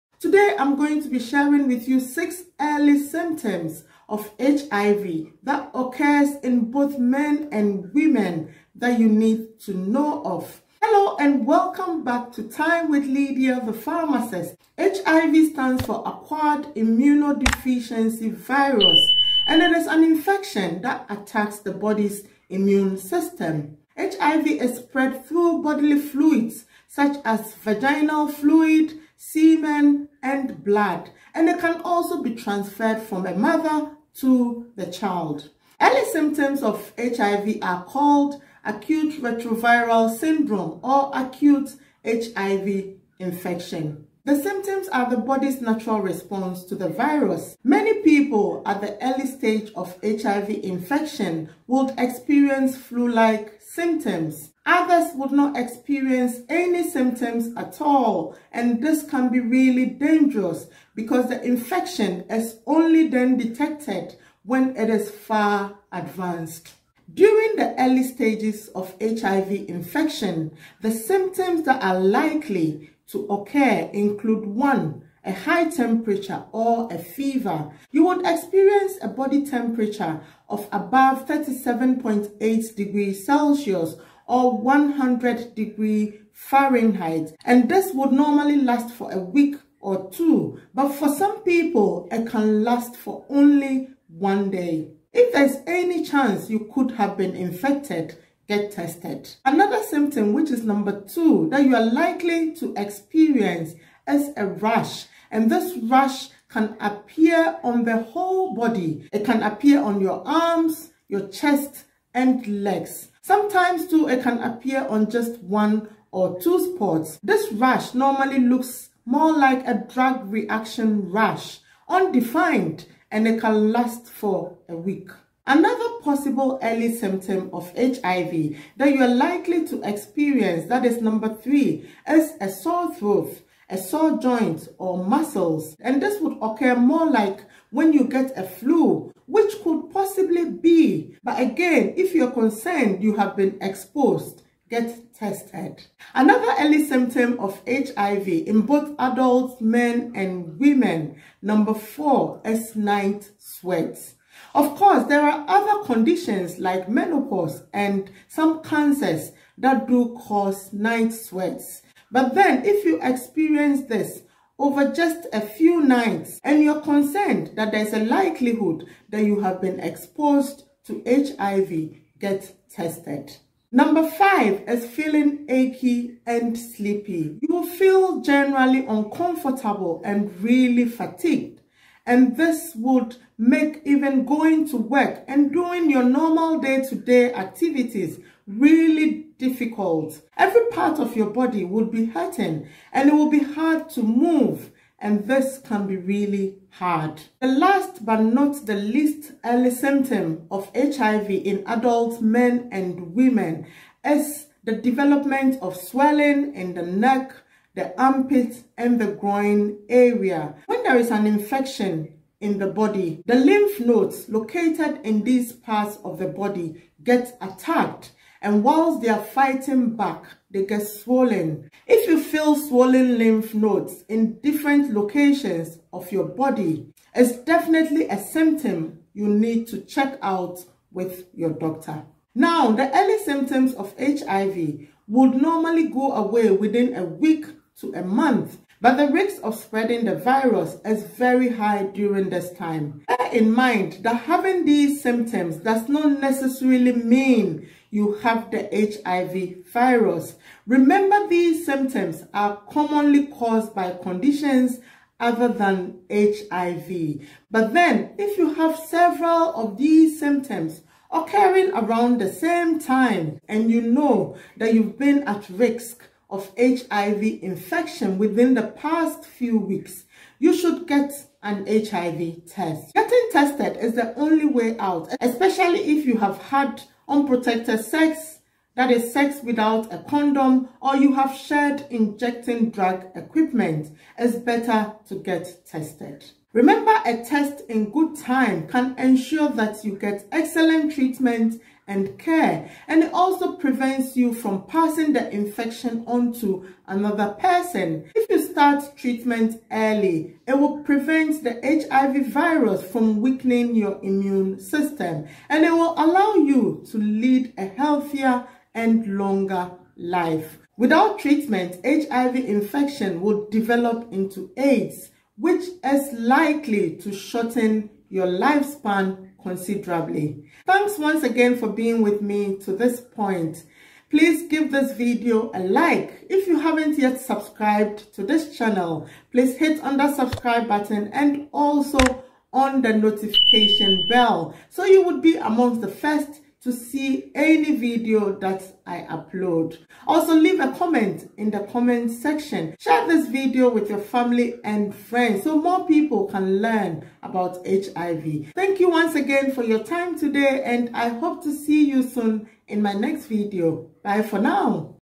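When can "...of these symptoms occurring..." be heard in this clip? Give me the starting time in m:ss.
4:19.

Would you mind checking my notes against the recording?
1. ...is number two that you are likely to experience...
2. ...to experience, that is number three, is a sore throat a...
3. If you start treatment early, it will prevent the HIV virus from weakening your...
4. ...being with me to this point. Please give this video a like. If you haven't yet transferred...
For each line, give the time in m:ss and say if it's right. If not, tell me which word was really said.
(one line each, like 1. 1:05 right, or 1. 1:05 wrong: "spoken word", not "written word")
1. 1:40 right
2. 2:09 right
3. 4:58 right
4. 5:21 wrong: "subscribed", not "transferred".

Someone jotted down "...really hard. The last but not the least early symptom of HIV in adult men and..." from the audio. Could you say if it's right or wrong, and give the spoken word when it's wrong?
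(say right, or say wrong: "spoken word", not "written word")
right.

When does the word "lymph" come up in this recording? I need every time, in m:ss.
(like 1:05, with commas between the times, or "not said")
3:33, 3:43.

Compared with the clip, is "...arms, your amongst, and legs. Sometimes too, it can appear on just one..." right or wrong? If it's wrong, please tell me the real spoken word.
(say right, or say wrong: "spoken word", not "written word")
wrong: "chest", not "amongst".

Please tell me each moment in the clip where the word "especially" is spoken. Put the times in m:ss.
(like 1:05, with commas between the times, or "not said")
4:35.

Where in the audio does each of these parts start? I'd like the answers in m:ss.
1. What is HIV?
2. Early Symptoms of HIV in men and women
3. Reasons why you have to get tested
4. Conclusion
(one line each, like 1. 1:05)
1. 0:14
2. 0:35
3. 4:17
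4. 5:20.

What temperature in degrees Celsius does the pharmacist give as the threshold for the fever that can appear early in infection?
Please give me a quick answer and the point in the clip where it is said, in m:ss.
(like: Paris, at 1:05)
37.8, at 1:21.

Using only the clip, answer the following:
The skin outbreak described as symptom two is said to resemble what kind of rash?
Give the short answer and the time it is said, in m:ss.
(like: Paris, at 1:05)
drug reaction rash, at 1:59.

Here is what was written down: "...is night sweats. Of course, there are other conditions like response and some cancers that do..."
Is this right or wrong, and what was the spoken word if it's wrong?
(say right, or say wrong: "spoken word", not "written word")
wrong: "menopause", not "response".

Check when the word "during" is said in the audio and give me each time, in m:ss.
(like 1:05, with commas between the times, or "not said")
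1:07, 4:01.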